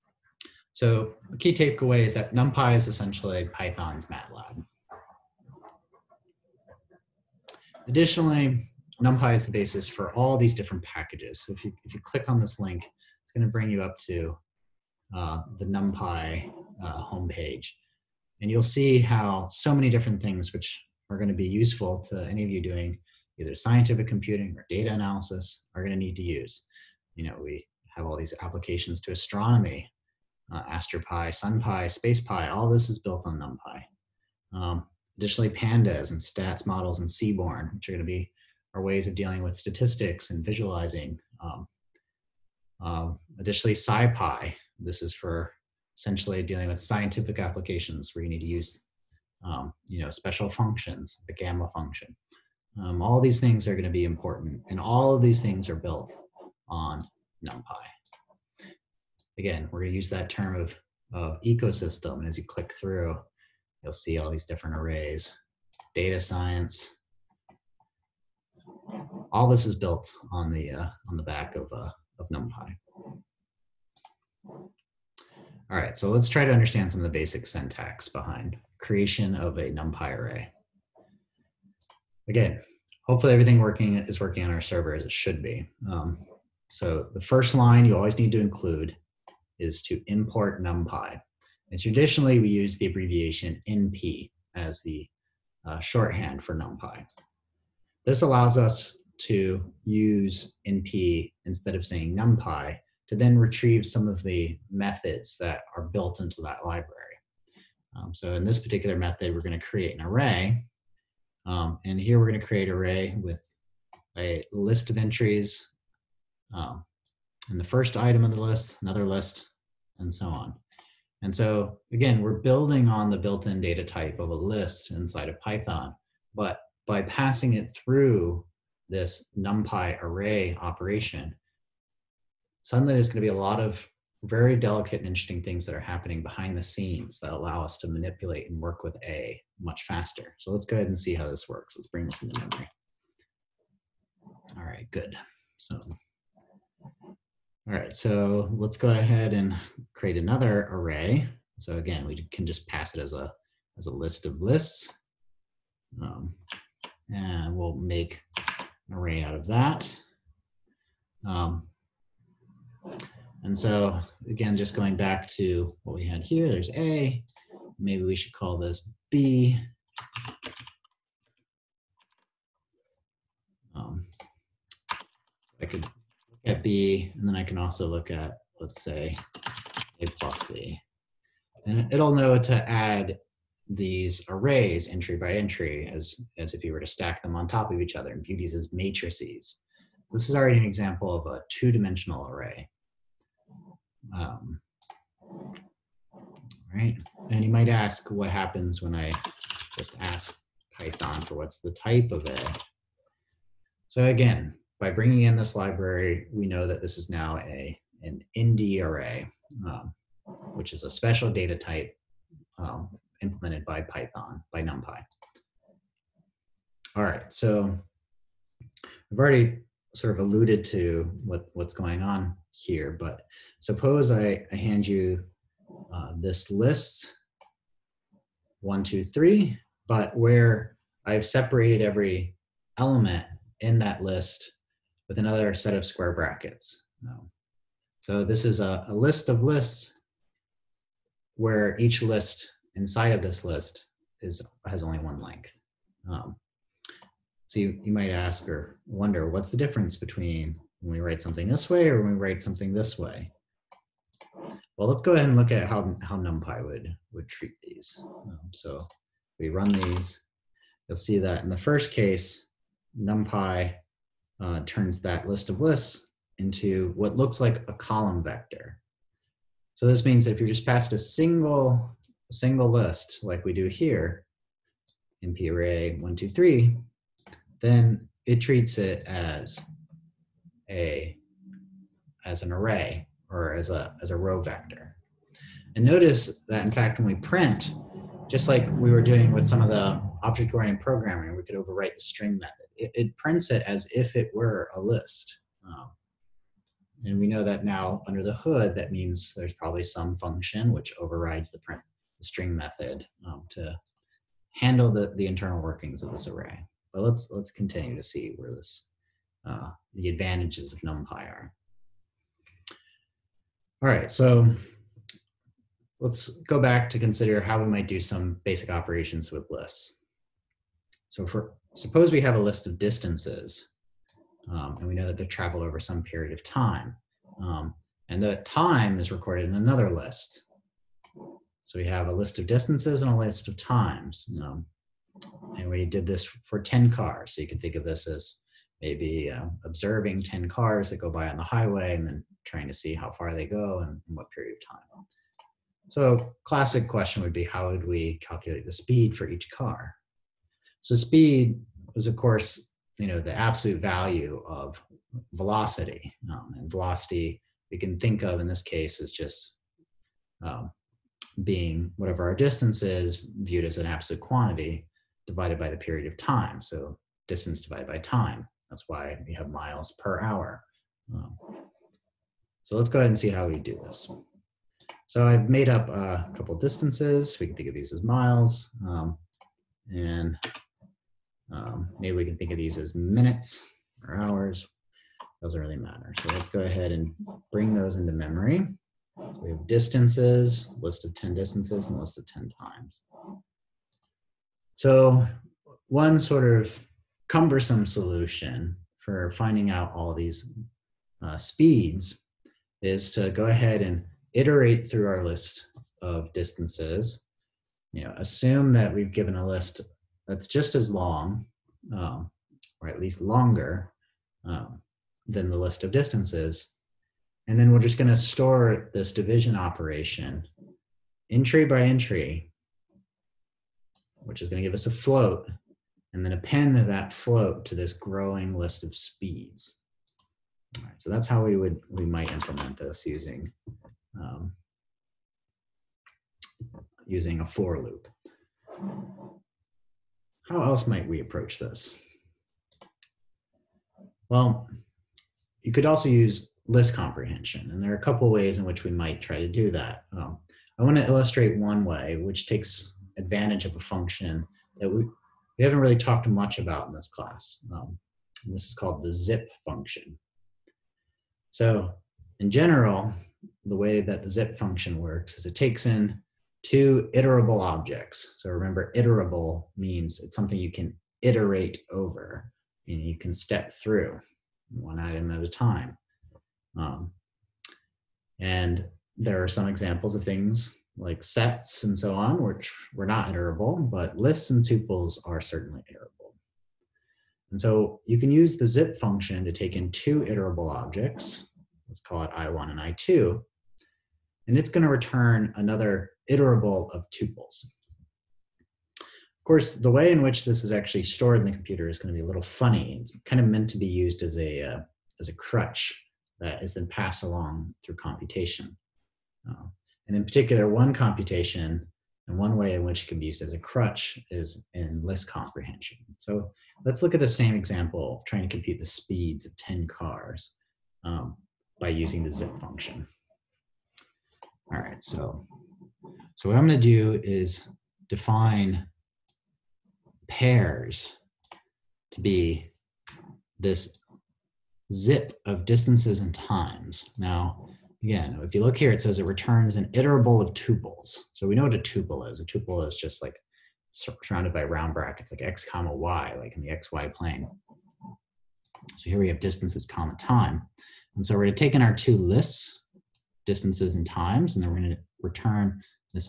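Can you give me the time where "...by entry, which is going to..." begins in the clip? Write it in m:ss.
7:01.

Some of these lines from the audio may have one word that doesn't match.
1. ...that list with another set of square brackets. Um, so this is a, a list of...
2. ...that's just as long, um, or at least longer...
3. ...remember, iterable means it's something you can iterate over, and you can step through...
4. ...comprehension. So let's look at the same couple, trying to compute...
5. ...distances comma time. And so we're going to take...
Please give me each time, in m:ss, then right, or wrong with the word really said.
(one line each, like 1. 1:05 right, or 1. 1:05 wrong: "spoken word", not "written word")
1. 3:53 right
2. 6:50 right
3. 7:48 right
4. 8:35 wrong: "example", not "couple"
5. 9:09 right.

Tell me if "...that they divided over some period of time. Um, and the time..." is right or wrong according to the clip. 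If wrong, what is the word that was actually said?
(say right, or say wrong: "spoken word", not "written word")
wrong: "traveled", not "divided".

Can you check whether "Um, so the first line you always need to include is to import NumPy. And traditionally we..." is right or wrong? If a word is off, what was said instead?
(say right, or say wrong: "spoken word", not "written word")
right.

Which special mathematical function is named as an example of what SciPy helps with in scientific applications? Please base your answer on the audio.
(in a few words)
gamma function.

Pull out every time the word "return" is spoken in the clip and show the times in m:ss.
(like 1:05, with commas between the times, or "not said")
8:14, 8:59, 9:15.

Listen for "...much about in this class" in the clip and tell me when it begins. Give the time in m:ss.
7:36.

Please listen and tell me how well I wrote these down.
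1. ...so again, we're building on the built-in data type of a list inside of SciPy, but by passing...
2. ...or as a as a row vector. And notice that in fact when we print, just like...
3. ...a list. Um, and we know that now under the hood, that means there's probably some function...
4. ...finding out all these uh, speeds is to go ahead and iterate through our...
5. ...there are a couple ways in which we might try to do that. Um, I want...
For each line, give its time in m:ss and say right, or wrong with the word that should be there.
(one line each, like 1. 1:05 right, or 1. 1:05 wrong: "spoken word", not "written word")
1. 2:01 wrong: "Python", not "SciPy"
2. 4:43 right
3. 4:54 right
4. 6:39 right
5. 7:27 right.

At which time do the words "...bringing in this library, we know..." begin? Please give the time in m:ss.
3:24.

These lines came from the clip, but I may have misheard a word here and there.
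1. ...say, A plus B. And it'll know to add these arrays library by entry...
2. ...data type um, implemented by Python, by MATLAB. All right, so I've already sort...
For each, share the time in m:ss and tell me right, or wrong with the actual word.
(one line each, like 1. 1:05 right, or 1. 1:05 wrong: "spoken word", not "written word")
1. 2:58 wrong: "entry", not "library"
2. 3:31 wrong: "NumPy", not "MATLAB".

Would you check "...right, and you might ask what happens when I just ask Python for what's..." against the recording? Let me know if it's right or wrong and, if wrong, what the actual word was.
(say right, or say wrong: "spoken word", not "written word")
right.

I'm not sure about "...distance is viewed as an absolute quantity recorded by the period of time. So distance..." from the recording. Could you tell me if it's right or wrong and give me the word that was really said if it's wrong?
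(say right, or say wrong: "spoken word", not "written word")
wrong: "divided", not "recorded".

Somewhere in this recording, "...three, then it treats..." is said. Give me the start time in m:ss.
4:36.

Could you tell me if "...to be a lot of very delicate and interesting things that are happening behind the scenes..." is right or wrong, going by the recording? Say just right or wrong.
right.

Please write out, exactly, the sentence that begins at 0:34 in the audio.
Um, additionally, pandas and statsmodels and Seaborn, which are going to be our ways of dealing with statistics and visualizing.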